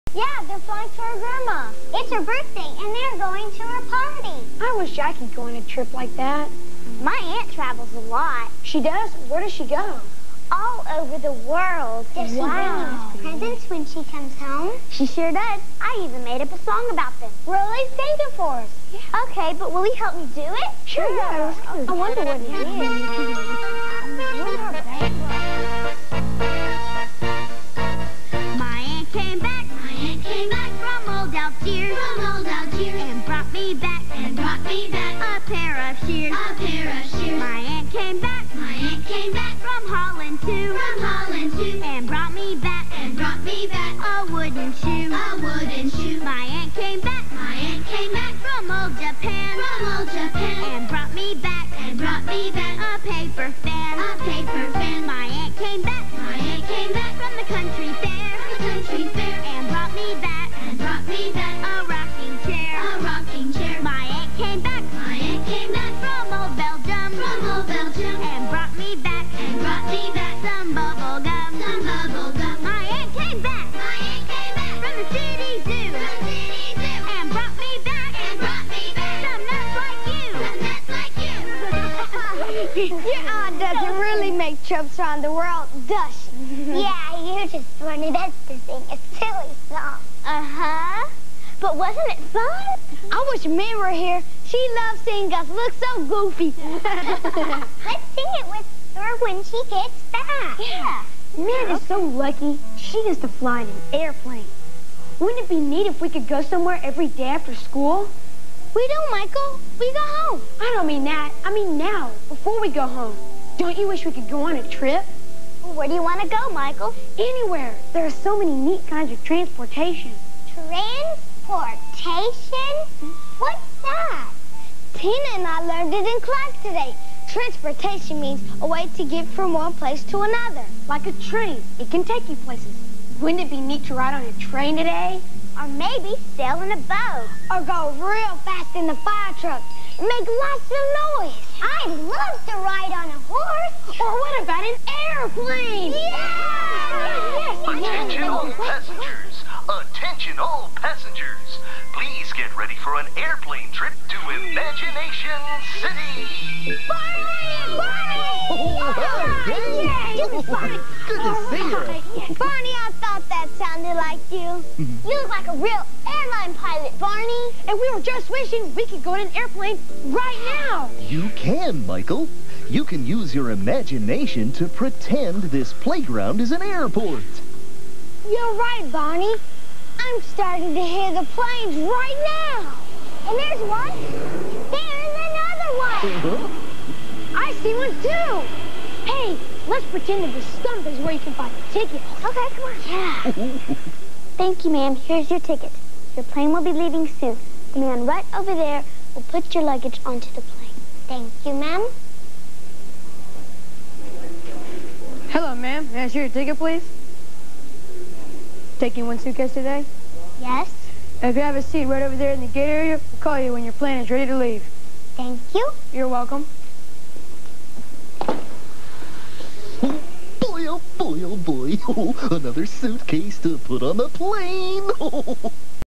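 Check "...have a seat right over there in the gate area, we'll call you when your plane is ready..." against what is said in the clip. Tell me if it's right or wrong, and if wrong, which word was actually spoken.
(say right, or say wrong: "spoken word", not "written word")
right.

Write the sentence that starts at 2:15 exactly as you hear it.
or maybe sail in a boat.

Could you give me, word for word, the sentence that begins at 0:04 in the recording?
I wish I could go on a trip like that.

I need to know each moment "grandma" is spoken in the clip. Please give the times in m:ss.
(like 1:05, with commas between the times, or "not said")
0:01.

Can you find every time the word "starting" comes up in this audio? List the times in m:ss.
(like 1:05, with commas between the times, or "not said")
3:00.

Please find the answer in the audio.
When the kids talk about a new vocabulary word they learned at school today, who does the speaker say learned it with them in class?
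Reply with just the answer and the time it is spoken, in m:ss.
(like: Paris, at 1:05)
Tina, at 2:04.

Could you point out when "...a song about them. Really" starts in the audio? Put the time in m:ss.
0:16.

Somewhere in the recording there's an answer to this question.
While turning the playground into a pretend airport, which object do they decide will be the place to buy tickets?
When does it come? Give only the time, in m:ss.
3:10.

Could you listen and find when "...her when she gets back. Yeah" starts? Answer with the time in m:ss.
1:38.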